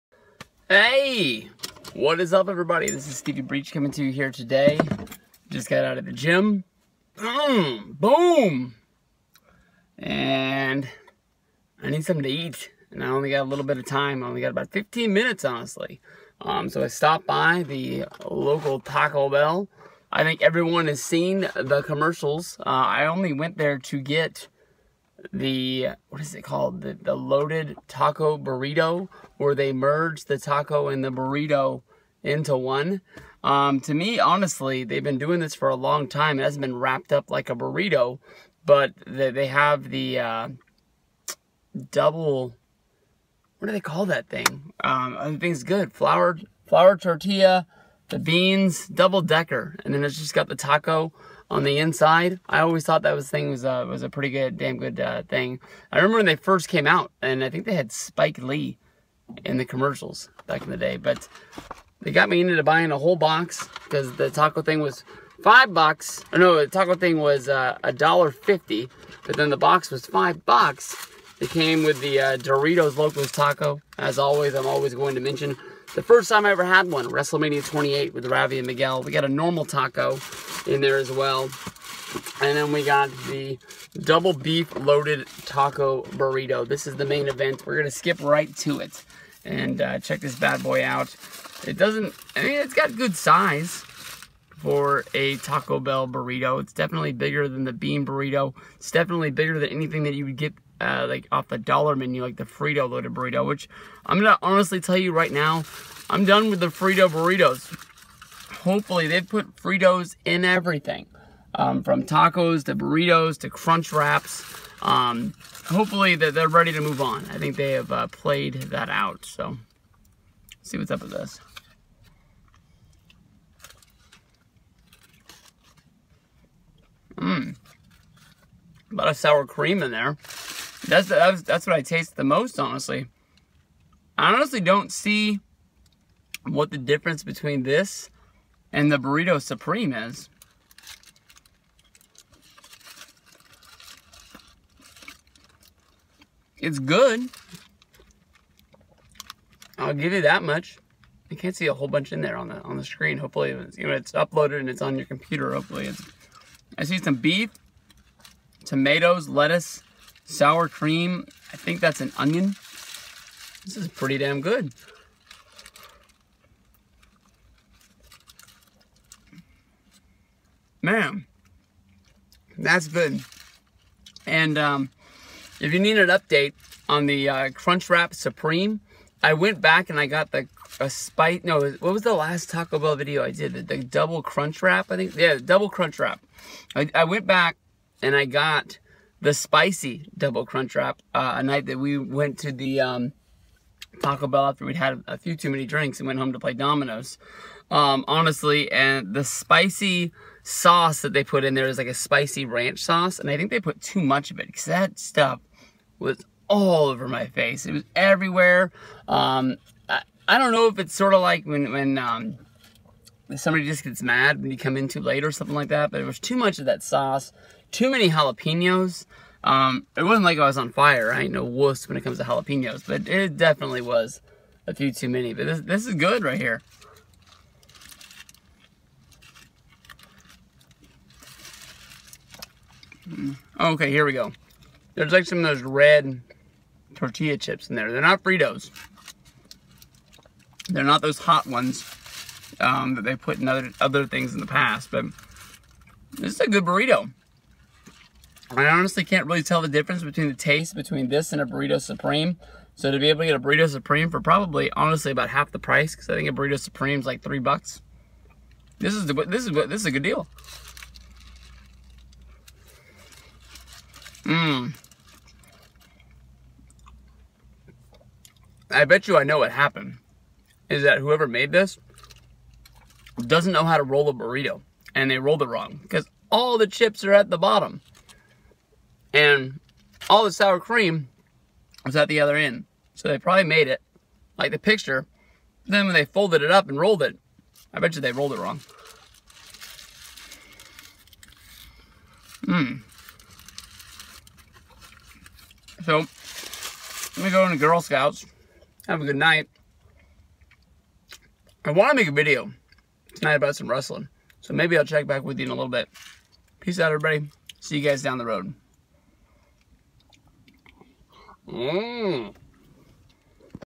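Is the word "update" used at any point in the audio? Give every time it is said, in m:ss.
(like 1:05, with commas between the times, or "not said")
2:56.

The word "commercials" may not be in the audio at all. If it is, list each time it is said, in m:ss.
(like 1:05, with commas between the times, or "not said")
0:21, 0:59.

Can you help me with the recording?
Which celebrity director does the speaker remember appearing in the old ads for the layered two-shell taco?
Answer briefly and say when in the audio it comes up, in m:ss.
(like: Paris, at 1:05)
Spike Lee, at 0:57.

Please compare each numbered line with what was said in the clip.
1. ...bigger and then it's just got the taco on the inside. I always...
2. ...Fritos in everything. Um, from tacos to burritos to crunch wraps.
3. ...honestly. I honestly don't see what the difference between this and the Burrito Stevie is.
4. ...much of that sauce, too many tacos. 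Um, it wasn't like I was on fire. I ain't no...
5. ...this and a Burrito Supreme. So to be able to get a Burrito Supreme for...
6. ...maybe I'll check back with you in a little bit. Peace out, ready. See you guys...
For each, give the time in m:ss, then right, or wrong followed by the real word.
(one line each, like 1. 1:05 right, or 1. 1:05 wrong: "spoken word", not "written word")
1. 0:49 wrong: "decker", not "bigger"
2. 1:49 right
3. 2:12 wrong: "Supreme", not "Stevie"
4. 3:36 wrong: "jalapenos", not "tacos"
5. 4:11 right
6. 5:04 wrong: "everybody", not "ready".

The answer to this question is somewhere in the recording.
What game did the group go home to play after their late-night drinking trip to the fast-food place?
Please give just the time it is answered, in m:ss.
3:16.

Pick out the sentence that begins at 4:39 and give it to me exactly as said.
And all the sour cream was at the other end.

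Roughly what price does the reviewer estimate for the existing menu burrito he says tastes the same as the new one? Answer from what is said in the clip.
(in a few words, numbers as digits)
$3.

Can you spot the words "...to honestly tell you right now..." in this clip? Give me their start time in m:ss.
1:44.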